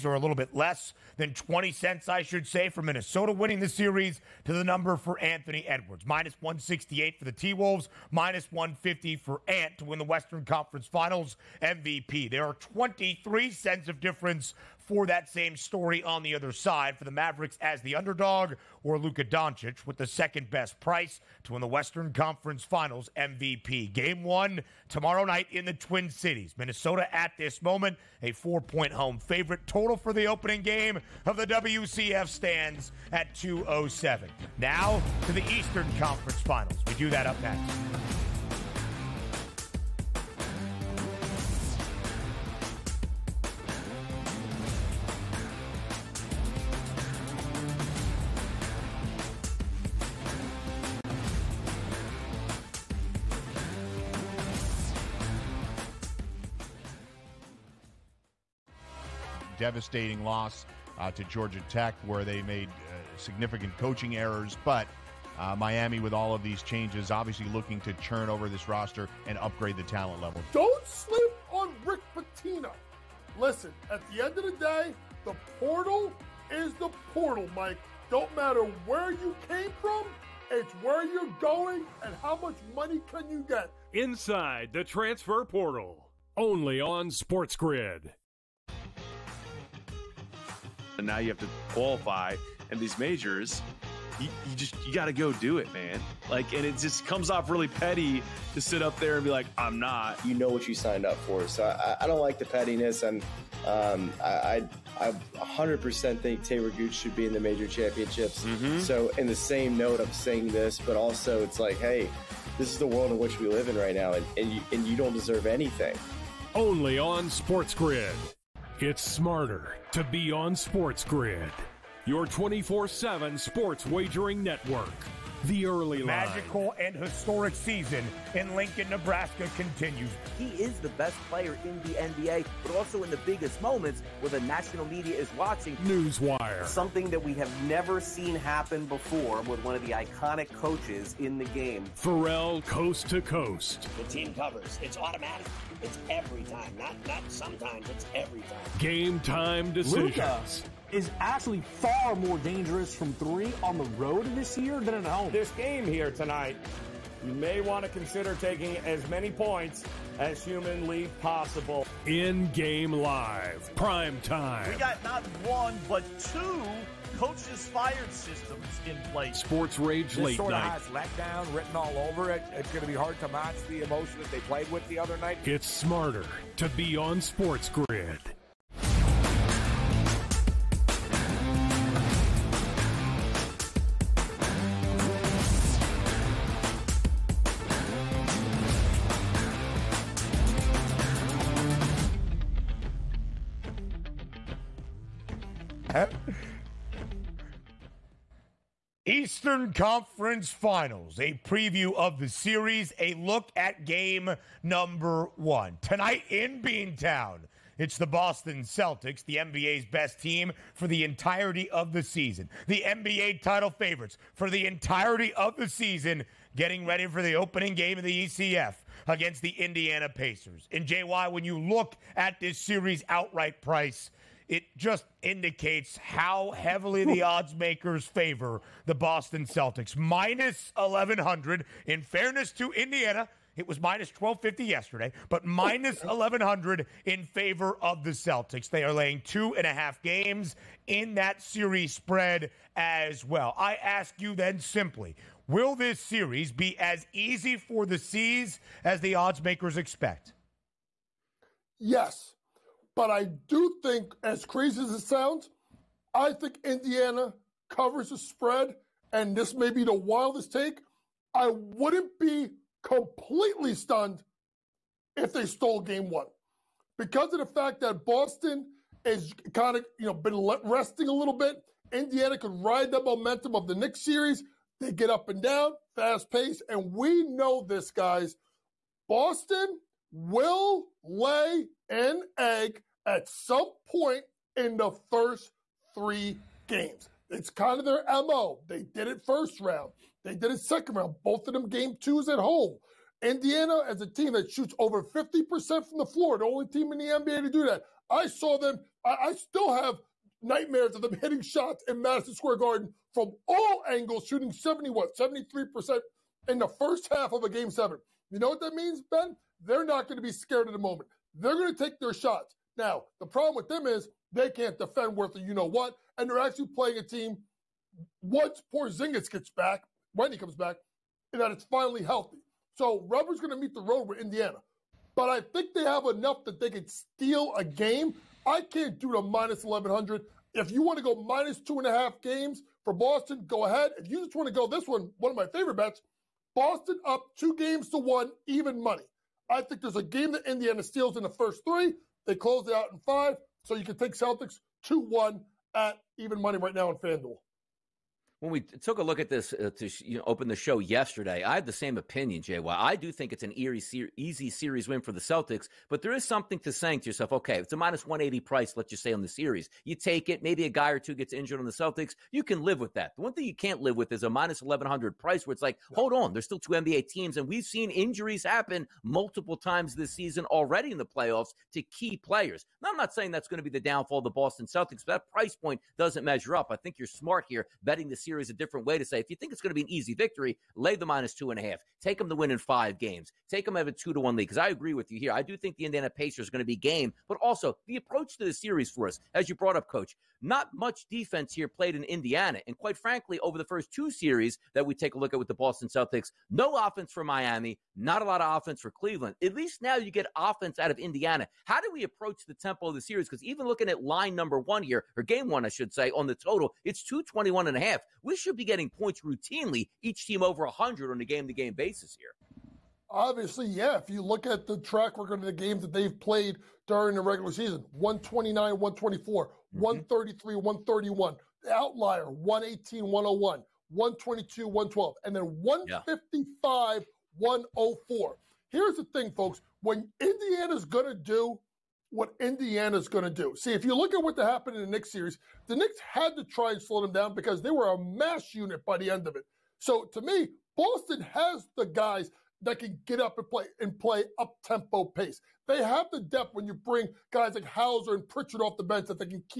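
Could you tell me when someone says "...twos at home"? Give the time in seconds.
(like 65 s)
291 s.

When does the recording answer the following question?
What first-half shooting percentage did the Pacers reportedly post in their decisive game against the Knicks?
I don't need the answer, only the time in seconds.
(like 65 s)
305 s.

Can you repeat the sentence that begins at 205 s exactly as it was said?
Tonight in Beantown, it's the Boston Celtics, the NBA's best team for the entirety of the season.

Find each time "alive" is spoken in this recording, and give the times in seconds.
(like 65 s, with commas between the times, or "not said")
not said.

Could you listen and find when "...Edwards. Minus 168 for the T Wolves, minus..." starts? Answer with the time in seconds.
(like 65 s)
5 s.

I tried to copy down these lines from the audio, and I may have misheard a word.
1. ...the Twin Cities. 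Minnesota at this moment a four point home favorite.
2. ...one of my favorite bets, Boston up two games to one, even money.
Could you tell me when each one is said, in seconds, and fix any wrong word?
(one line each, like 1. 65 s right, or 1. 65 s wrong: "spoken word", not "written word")
1. 25 s right
2. 335 s right.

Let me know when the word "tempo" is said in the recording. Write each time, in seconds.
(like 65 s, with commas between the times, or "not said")
402 s, 444 s.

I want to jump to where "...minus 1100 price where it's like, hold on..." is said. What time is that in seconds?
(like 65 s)
364 s.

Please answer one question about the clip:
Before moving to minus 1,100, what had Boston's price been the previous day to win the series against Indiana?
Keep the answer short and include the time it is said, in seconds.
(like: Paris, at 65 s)
-1250, at 233 s.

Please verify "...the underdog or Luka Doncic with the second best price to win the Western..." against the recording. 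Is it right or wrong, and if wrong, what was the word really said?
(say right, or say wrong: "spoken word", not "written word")
right.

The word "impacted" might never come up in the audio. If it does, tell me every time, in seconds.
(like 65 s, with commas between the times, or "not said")
not said.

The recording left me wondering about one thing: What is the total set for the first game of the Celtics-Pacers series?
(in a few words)
221.5.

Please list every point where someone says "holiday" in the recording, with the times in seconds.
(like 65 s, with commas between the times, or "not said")
not said.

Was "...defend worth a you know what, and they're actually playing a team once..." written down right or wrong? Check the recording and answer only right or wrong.
right.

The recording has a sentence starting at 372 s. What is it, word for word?
Now, I'm not saying that's going to be the downfall of the Boston Celtics, but that price point doesn't measure up.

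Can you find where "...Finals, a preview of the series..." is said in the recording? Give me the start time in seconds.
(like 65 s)
200 s.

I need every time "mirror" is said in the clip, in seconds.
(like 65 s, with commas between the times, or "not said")
not said.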